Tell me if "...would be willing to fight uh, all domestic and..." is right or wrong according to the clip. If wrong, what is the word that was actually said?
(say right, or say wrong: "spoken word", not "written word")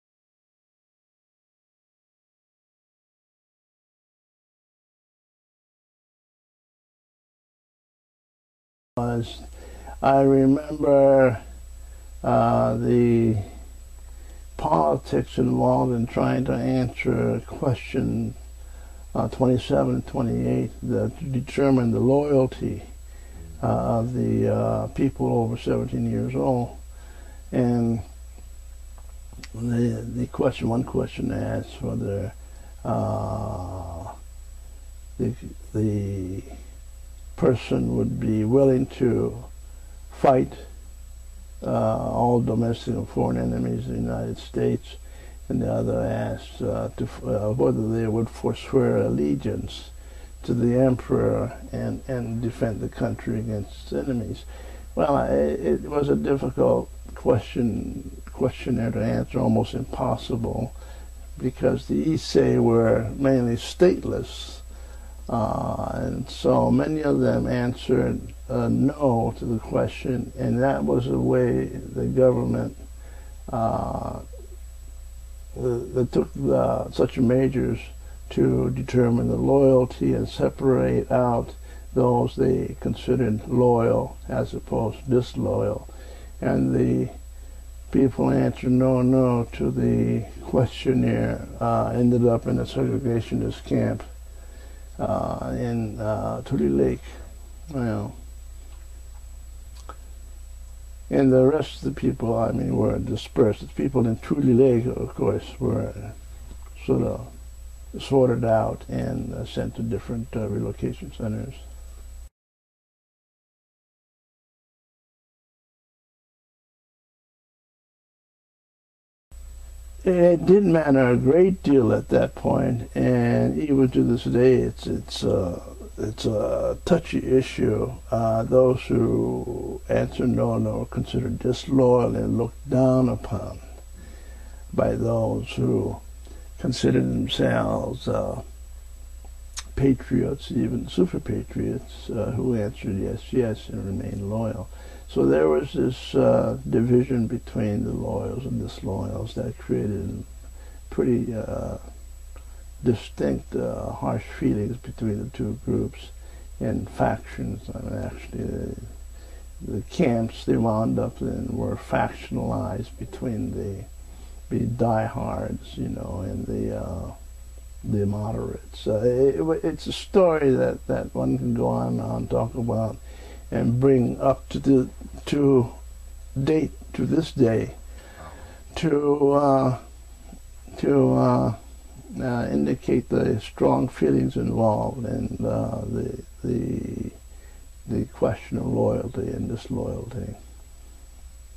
right.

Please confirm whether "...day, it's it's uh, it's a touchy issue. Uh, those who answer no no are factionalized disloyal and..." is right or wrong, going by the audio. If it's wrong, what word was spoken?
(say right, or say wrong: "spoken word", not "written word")
wrong: "considered", not "factionalized".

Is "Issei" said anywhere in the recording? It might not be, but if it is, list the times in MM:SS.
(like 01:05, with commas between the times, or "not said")
01:02.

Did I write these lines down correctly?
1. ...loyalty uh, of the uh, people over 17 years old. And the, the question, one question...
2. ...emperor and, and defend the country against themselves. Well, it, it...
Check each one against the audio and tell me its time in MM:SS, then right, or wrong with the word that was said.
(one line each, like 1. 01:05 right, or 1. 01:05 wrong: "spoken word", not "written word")
1. 00:21 right
2. 00:50 wrong: "enemies", not "themselves".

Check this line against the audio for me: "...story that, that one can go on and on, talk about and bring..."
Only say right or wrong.
right.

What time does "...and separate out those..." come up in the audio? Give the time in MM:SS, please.
01:20.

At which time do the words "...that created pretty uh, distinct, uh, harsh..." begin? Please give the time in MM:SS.
02:29.